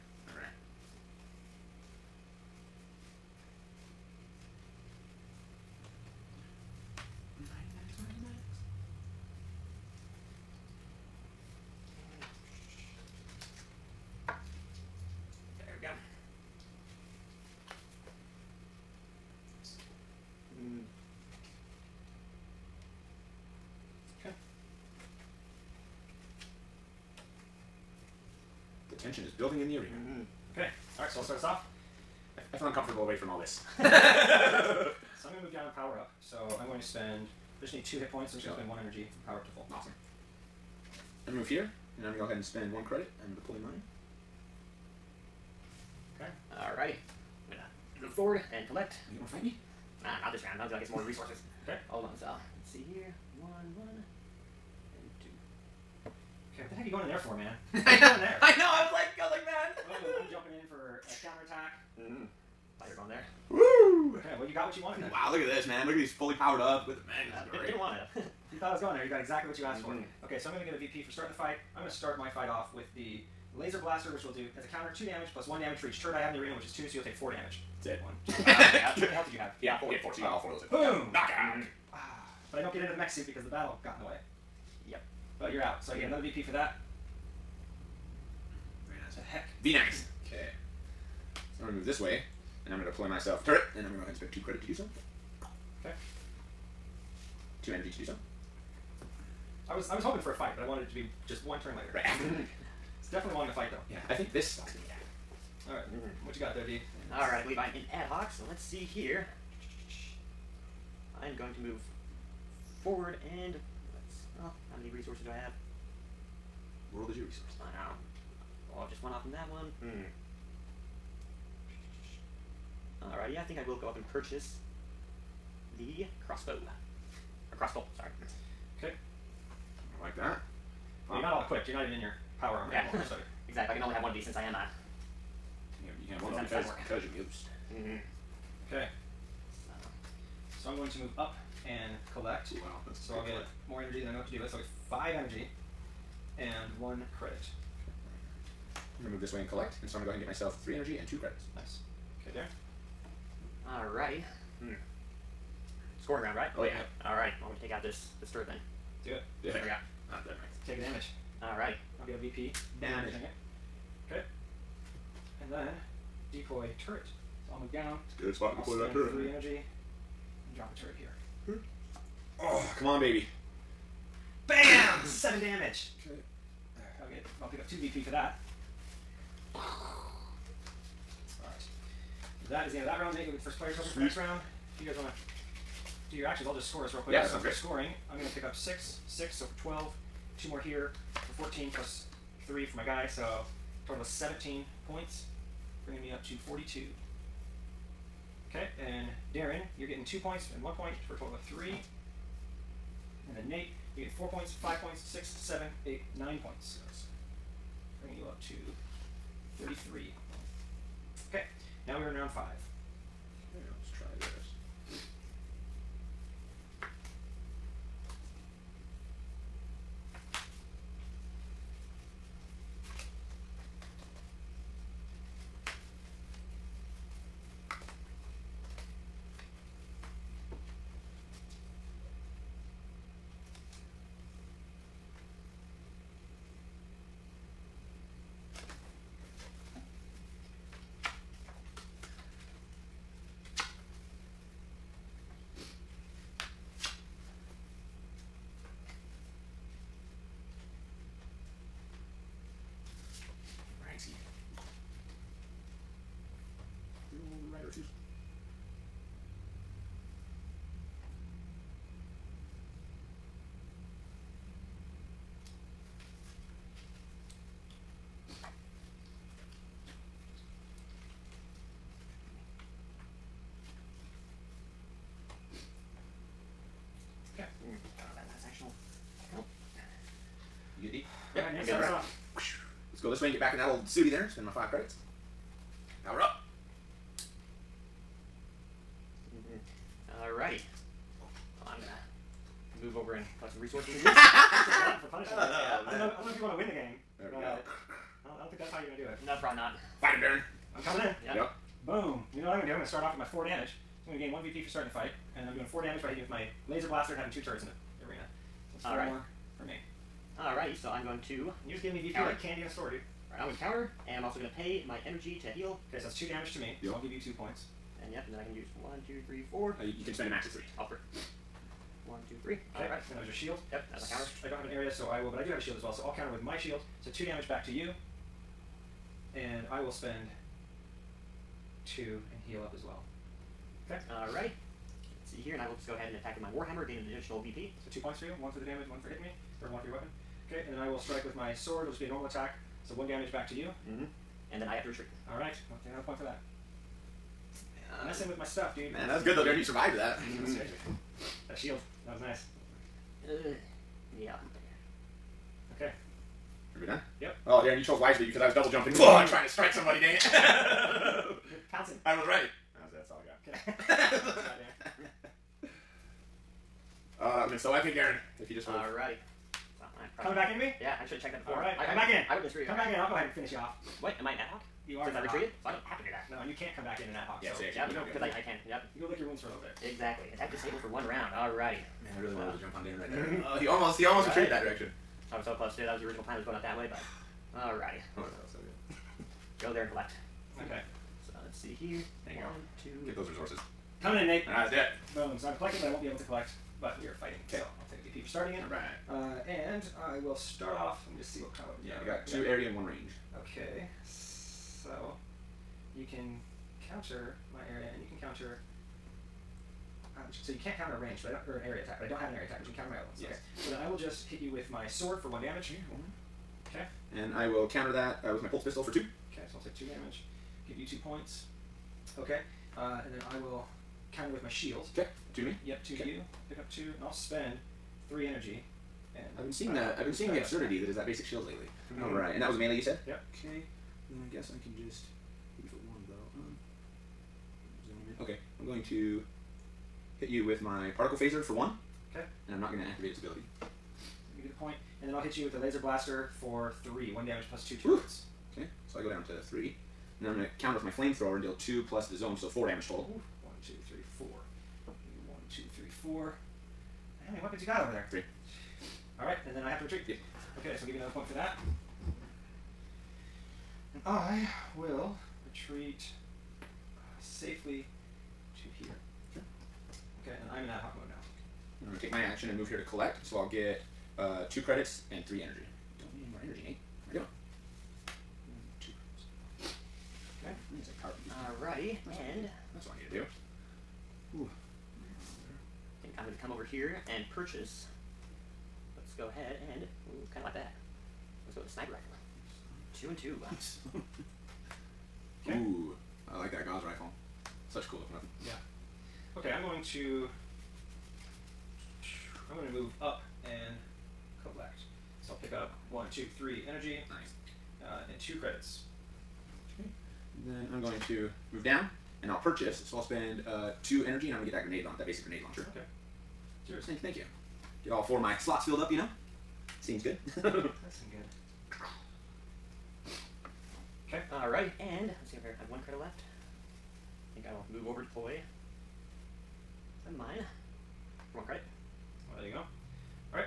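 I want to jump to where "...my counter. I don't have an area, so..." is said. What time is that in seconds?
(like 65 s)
324 s.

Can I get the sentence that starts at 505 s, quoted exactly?
So I'll pick up one, two, three energy.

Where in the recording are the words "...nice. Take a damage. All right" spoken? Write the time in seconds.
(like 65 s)
160 s.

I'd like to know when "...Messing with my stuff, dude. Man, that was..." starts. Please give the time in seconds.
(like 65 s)
348 s.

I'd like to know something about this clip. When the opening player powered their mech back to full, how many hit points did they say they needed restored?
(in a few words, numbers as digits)
2.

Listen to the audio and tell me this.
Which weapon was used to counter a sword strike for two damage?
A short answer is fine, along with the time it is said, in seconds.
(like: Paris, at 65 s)
pulse pistol, at 418 s.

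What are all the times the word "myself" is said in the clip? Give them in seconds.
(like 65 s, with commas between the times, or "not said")
93 s, 150 s.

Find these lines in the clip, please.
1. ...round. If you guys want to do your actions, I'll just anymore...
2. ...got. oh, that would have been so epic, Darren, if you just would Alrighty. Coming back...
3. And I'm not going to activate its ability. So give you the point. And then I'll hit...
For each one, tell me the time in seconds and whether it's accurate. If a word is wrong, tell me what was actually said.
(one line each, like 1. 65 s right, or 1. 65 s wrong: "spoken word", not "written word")
1. 184 s wrong: "score", not "anymore"
2. 363 s right
3. 442 s right.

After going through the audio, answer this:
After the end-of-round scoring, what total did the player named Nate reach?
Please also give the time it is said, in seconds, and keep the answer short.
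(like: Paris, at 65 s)
33, at 209 s.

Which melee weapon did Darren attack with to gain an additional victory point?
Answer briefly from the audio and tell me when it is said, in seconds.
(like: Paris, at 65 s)
Warhammer, at 336 s.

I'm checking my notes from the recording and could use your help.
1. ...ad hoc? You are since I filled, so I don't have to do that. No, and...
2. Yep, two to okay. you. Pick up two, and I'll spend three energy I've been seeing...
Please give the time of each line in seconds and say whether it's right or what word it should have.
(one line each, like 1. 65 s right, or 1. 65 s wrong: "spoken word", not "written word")
1. 374 s wrong: "retreated", not "filled"
2. 425 s right.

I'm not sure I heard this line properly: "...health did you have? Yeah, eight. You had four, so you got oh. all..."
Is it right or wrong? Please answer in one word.
wrong.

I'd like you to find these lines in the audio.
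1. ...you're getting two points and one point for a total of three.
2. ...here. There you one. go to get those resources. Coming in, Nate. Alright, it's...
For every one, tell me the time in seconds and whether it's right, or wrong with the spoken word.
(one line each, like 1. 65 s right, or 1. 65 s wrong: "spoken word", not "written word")
1. 199 s right
2. 391 s right.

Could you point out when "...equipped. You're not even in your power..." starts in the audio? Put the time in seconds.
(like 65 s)
131 s.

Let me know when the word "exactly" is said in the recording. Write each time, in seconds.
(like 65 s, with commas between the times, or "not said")
69 s, 133 s, 379 s.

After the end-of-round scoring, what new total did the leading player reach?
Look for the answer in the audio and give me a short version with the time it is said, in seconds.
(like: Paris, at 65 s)
42, at 196 s.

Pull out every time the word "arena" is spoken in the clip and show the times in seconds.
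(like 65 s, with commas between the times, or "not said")
29 s, 76 s, 308 s.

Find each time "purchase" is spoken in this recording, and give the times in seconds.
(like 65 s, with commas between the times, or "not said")
124 s, 487 s, 512 s.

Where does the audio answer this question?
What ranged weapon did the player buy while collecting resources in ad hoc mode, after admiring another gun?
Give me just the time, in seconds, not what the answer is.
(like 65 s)
491 s.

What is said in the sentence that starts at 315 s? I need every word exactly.
Okay, so that's two damage to me, yep.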